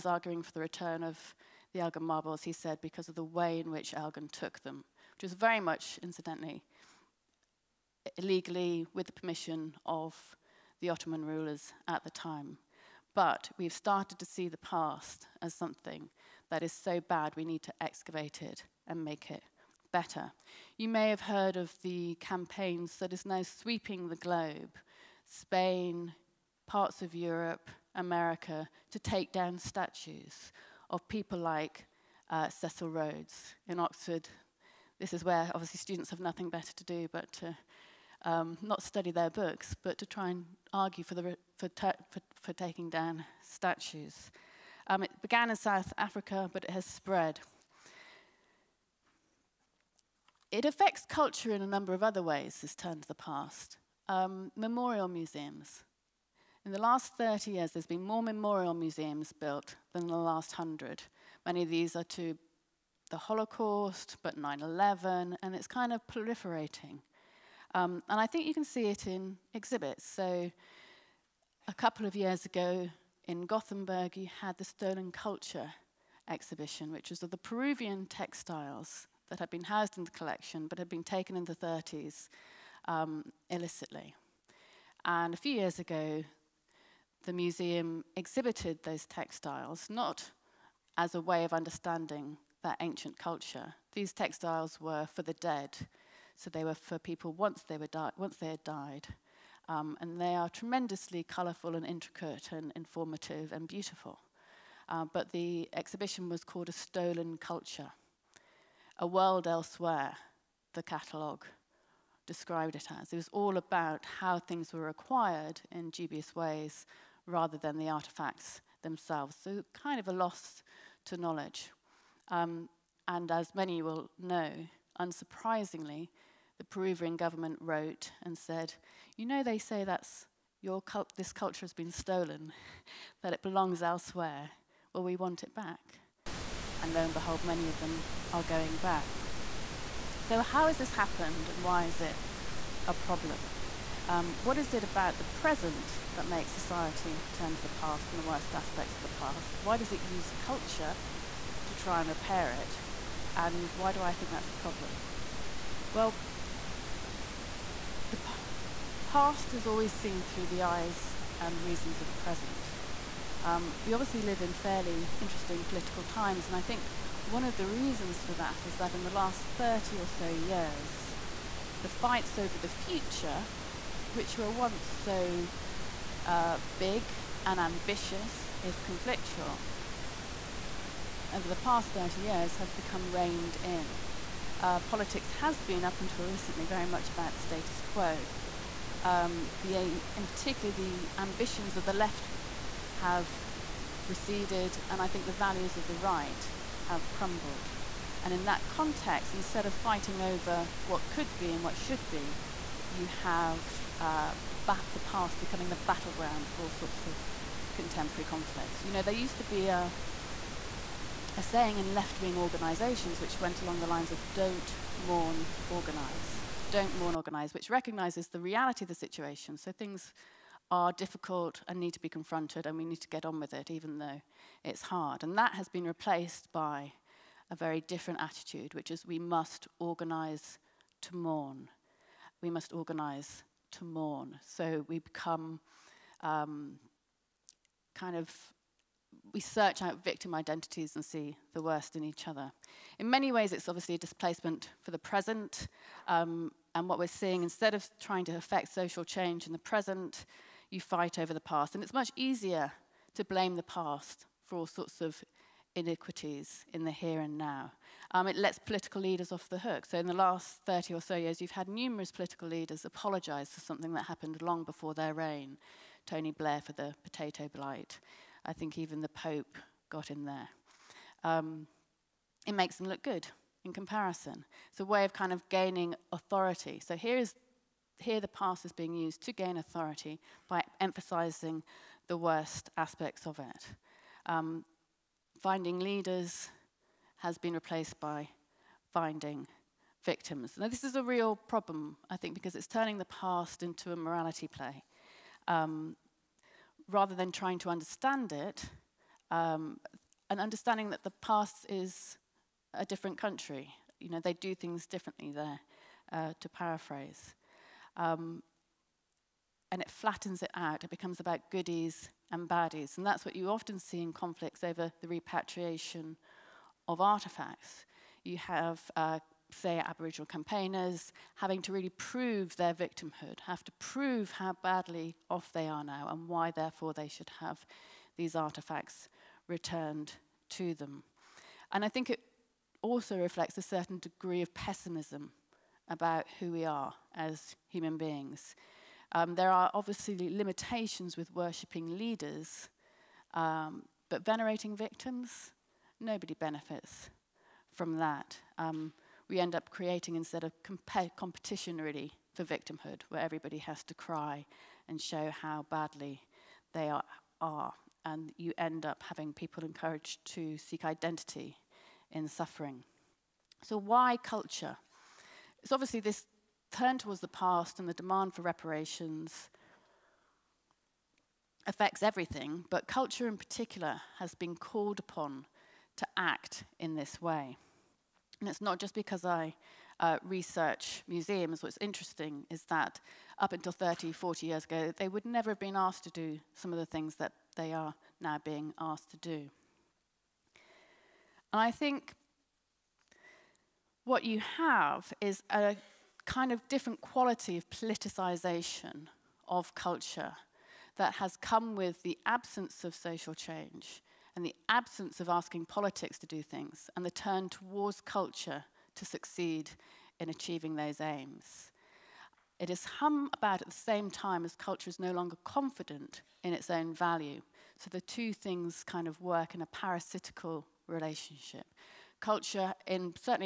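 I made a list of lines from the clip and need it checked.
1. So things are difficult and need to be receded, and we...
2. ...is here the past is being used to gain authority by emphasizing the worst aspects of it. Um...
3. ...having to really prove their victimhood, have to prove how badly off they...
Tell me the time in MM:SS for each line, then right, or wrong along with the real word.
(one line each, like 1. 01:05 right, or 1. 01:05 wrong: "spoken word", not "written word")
1. 03:39 wrong: "confronted", not "receded"
2. 04:37 right
3. 05:21 right.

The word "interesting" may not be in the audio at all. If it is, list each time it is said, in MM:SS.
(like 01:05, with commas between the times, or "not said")
02:45, 06:21.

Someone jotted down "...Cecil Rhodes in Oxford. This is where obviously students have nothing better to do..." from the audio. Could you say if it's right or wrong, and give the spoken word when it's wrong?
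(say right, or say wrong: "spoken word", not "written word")
right.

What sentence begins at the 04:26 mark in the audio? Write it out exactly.
Tony Blair for the potato blight.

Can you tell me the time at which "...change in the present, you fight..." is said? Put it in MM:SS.
04:09.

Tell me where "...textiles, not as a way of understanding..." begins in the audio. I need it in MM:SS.
01:29.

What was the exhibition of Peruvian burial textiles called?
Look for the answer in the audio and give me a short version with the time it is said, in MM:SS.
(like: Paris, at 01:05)
A Stolen Culture, at 01:46.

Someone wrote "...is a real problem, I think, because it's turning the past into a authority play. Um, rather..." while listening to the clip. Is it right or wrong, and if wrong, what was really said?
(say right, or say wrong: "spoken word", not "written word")
wrong: "morality", not "authority".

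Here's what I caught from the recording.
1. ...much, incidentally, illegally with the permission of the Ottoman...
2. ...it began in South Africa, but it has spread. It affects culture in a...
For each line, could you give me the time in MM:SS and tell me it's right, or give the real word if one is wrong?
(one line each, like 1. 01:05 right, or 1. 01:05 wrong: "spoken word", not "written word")
1. 00:05 right
2. 00:45 right.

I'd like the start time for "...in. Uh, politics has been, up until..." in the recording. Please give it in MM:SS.
03:03.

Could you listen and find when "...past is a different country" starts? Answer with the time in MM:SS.
05:01.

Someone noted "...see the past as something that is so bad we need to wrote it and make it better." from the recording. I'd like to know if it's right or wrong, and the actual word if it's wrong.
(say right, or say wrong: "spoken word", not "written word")
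wrong: "excavate", not "wrote".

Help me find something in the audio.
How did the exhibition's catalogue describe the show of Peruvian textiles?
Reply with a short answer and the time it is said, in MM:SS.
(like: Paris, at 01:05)
A World Elsewhere, at 01:48.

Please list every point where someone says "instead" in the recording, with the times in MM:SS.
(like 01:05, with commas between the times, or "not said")
03:19, 04:07, 05:50.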